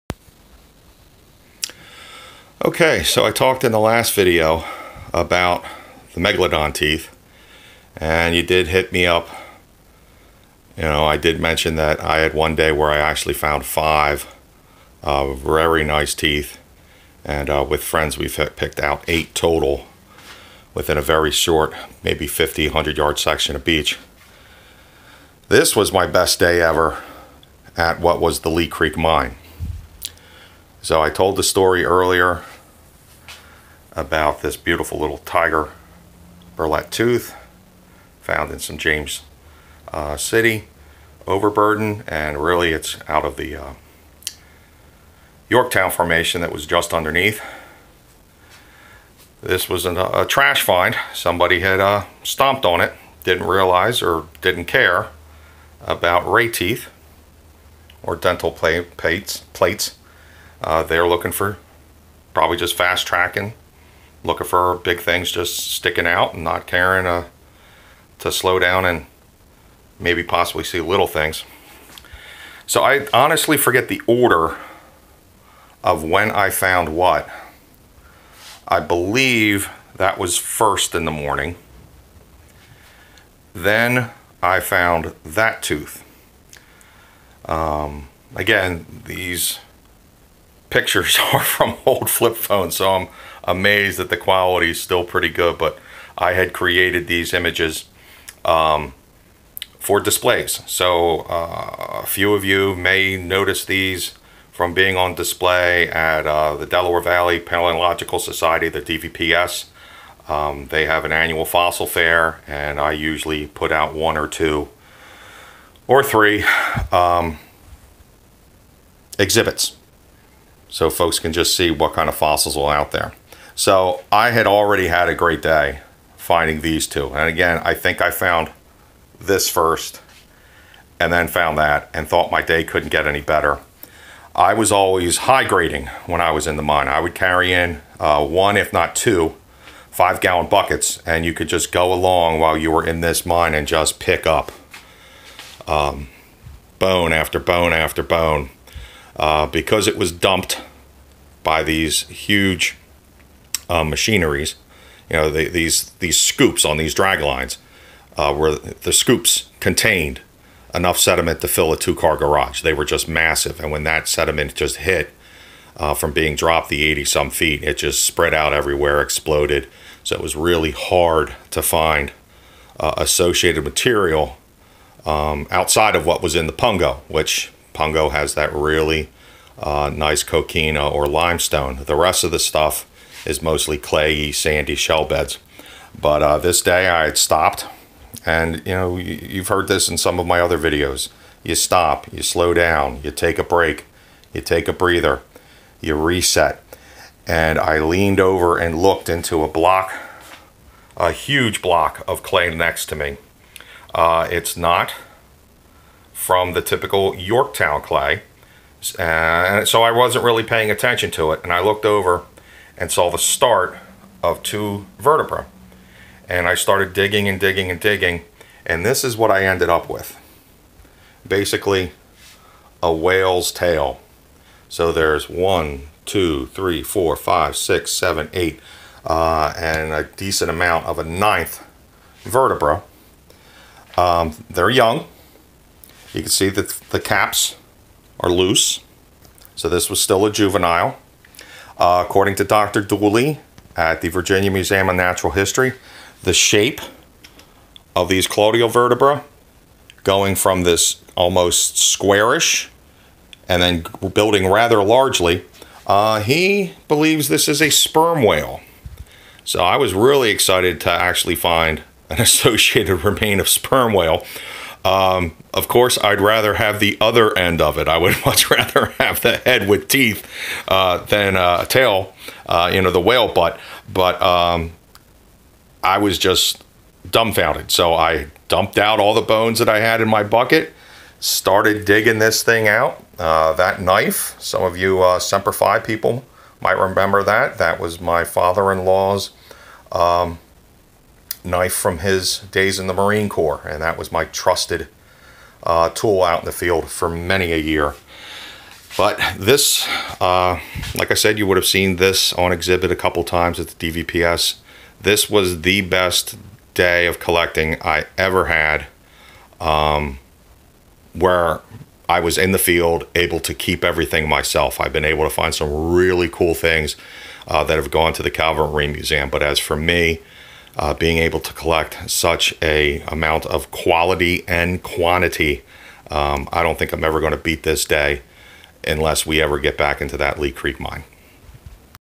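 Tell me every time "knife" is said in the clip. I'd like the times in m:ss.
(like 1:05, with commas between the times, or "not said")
4:43, 4:51.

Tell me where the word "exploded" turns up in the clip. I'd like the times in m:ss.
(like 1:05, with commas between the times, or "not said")
2:49.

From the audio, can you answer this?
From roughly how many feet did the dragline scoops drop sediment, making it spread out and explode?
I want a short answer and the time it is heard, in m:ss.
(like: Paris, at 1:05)
80, at 2:46.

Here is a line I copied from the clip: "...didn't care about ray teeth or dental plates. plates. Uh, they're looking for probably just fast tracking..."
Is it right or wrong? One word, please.
right.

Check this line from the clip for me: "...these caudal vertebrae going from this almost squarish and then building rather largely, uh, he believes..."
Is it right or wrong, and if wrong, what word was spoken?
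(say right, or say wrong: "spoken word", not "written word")
right.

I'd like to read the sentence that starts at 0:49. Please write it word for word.
This was an, a trash find.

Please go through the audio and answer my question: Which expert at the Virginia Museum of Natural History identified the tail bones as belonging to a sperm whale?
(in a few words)
Dr. Dooley.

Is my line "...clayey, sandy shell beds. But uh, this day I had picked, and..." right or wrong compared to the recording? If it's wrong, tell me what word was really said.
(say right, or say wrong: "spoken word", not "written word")
wrong: "stopped", not "picked".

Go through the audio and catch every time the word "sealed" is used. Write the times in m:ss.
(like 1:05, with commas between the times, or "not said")
not said.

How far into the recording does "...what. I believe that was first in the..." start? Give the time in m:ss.
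1:16.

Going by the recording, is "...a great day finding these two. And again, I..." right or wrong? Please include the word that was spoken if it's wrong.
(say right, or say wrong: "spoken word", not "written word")
right.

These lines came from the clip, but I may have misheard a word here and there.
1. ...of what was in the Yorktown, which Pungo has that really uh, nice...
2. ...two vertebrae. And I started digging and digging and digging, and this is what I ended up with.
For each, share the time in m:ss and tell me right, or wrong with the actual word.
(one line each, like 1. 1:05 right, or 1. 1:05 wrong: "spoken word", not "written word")
1. 2:55 wrong: "Pungo", not "Yorktown"
2. 3:34 right.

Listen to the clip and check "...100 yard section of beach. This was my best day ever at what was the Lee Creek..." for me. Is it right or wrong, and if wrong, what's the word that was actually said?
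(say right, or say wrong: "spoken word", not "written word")
right.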